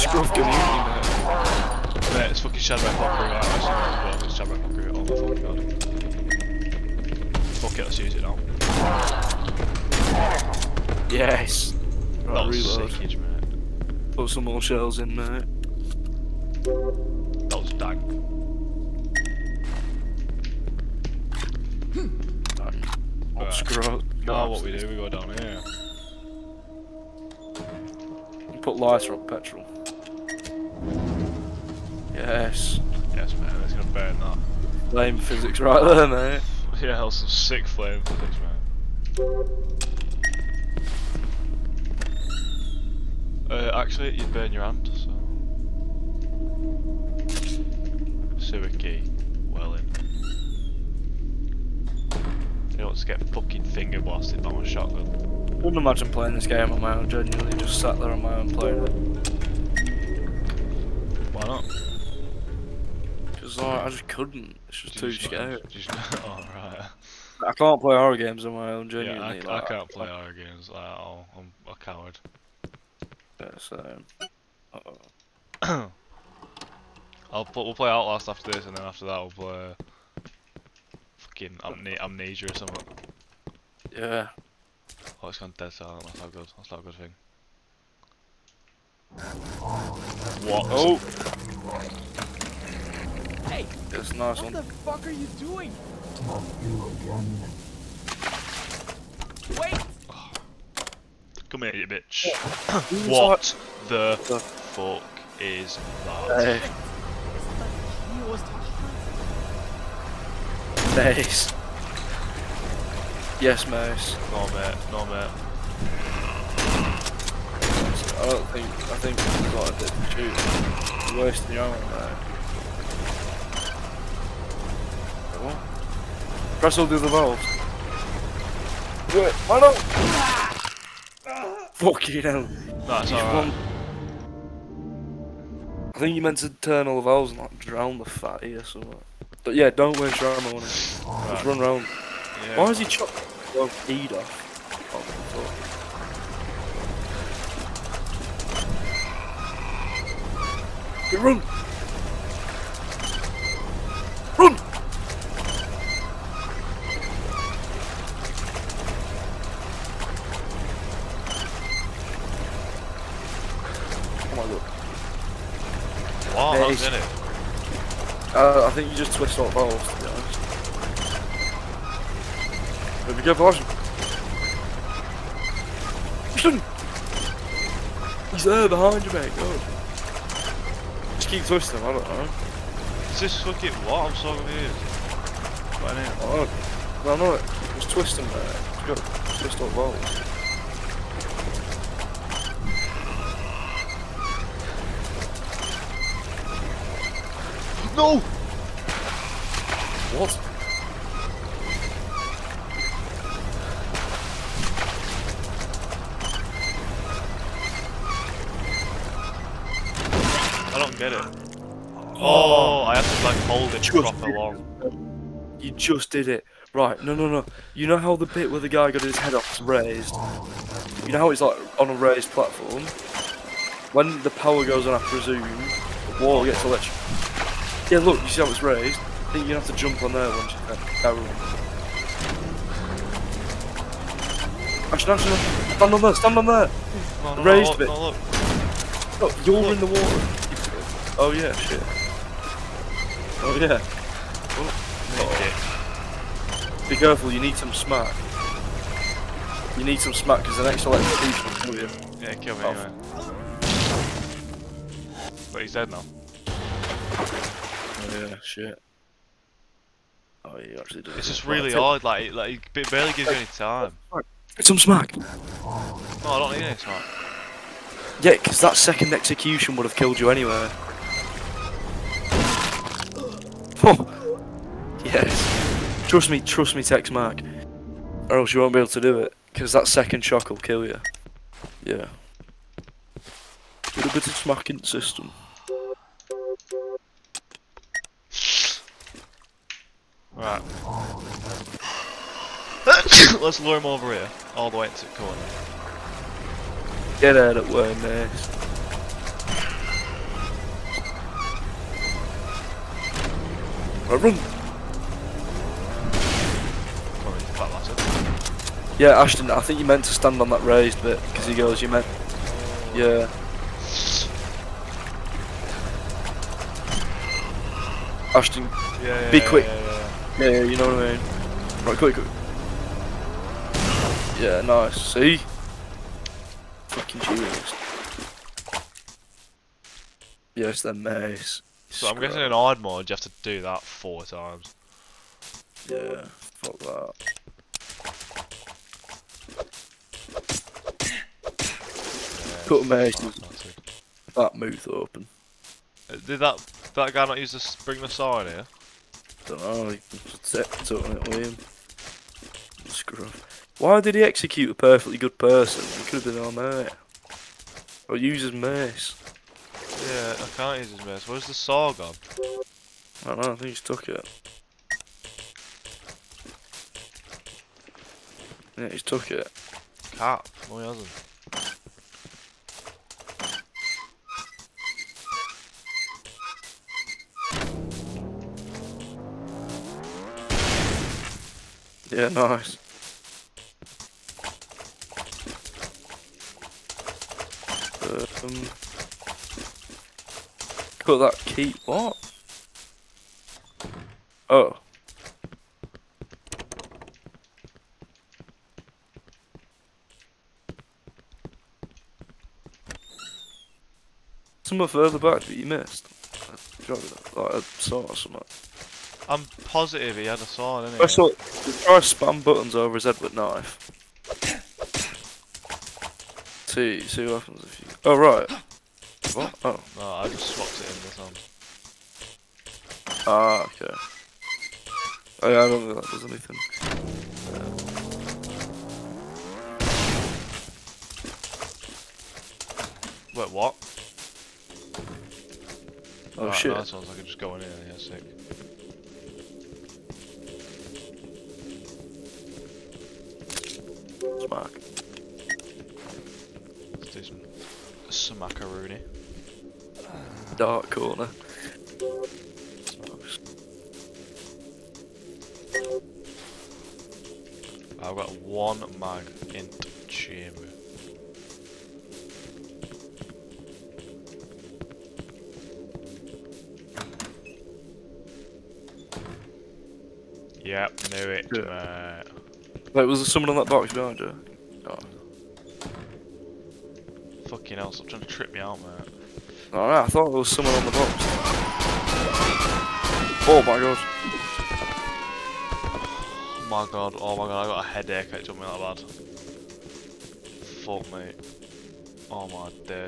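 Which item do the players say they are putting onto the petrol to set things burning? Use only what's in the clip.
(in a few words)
Lighter.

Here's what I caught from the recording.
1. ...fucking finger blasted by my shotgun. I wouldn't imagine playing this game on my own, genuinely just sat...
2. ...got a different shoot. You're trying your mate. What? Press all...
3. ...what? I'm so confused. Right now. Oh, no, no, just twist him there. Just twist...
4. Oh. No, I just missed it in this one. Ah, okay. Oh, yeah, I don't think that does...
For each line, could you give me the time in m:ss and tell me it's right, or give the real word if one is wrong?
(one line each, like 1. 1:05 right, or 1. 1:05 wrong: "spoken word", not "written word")
1. 0:53 right
2. 1:59 wrong: "wasting", not "trying"
3. 3:03 right
4. 6:59 wrong: "swapped", not "missed".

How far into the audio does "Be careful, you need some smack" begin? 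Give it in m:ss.
4:06.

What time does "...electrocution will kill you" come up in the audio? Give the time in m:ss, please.
4:10.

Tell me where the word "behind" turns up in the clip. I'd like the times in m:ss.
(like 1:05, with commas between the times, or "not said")
2:58, 7:53.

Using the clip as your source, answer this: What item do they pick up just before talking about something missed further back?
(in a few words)
Key.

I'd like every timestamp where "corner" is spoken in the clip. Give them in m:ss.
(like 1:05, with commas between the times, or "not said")
4:55, 7:30.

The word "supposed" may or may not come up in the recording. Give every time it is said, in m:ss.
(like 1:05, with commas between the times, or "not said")
not said.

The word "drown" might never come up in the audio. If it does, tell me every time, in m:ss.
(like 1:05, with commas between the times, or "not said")
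2:17.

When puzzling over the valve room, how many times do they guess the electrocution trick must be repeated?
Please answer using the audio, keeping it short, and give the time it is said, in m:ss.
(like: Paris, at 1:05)
4, at 5:33.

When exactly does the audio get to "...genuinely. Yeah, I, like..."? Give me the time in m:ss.
1:08.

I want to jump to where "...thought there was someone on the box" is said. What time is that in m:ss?
8:00.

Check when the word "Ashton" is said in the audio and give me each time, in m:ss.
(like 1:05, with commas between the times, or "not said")
5:09, 5:18.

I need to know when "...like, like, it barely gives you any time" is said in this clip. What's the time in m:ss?
4:22.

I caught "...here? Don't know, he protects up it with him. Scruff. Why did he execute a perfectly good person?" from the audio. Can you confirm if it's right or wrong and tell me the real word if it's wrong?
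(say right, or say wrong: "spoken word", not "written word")
right.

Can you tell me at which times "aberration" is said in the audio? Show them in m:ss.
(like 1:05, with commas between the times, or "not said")
not said.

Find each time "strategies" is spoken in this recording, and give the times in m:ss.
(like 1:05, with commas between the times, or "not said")
not said.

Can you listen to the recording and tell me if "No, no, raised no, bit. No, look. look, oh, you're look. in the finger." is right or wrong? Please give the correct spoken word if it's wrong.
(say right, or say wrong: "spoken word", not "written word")
wrong: "water", not "finger".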